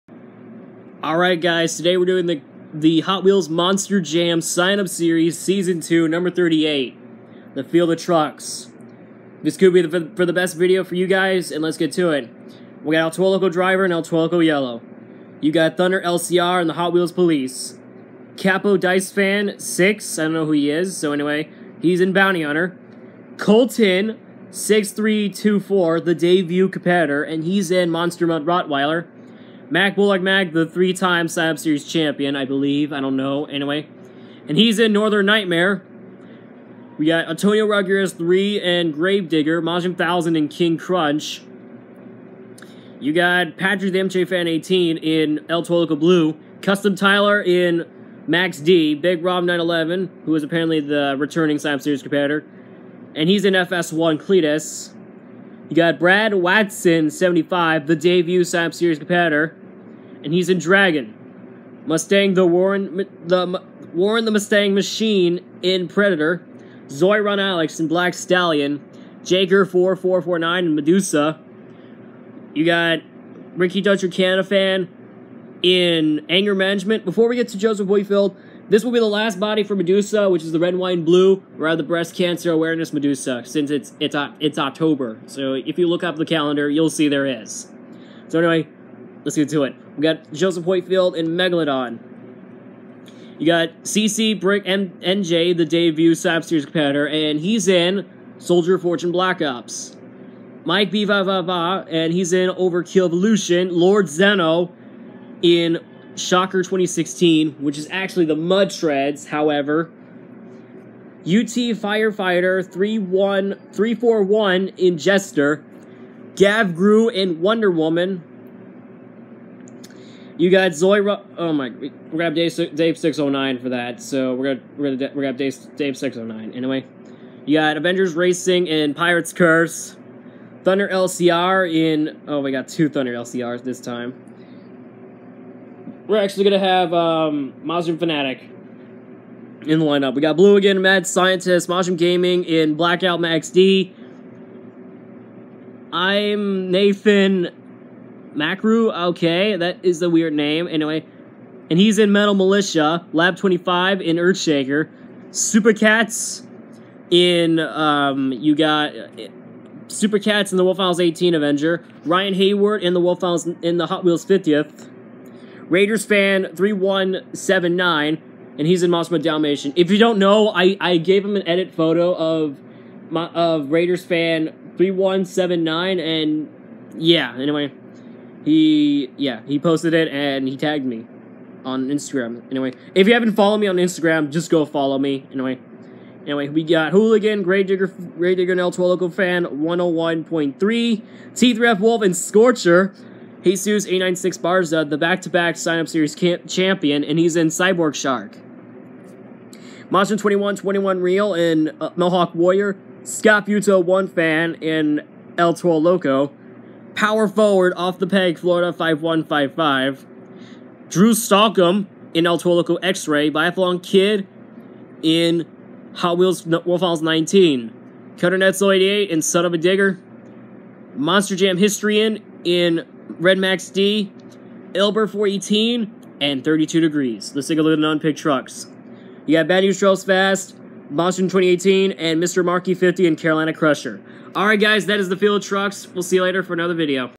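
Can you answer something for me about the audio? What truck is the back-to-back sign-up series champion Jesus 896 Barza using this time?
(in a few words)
Cyborg Shark.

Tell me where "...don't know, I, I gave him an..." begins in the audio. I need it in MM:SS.
02:49.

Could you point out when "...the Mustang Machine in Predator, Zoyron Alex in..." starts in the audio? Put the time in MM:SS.
01:04.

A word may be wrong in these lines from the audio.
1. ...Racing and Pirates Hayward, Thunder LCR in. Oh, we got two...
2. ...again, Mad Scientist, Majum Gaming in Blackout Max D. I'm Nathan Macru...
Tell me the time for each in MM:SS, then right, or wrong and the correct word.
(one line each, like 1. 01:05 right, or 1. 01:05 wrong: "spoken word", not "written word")
1. 02:08 wrong: "Curse", not "Hayward"
2. 02:20 right.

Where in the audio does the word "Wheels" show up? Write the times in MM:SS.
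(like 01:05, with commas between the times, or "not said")
00:03, 00:16, 02:44, 03:36.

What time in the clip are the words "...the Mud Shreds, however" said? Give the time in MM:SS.
01:48.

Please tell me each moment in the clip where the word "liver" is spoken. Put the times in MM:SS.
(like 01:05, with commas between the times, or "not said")
not said.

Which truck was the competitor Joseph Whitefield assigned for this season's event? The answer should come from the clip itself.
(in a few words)
Megalodon.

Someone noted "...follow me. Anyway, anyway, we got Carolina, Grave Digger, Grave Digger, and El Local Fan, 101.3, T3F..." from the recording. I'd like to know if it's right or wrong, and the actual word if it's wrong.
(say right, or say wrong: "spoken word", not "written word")
wrong: "Hooligan", not "Carolina".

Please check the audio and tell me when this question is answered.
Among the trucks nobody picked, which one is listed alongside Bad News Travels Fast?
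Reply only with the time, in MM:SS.
03:53.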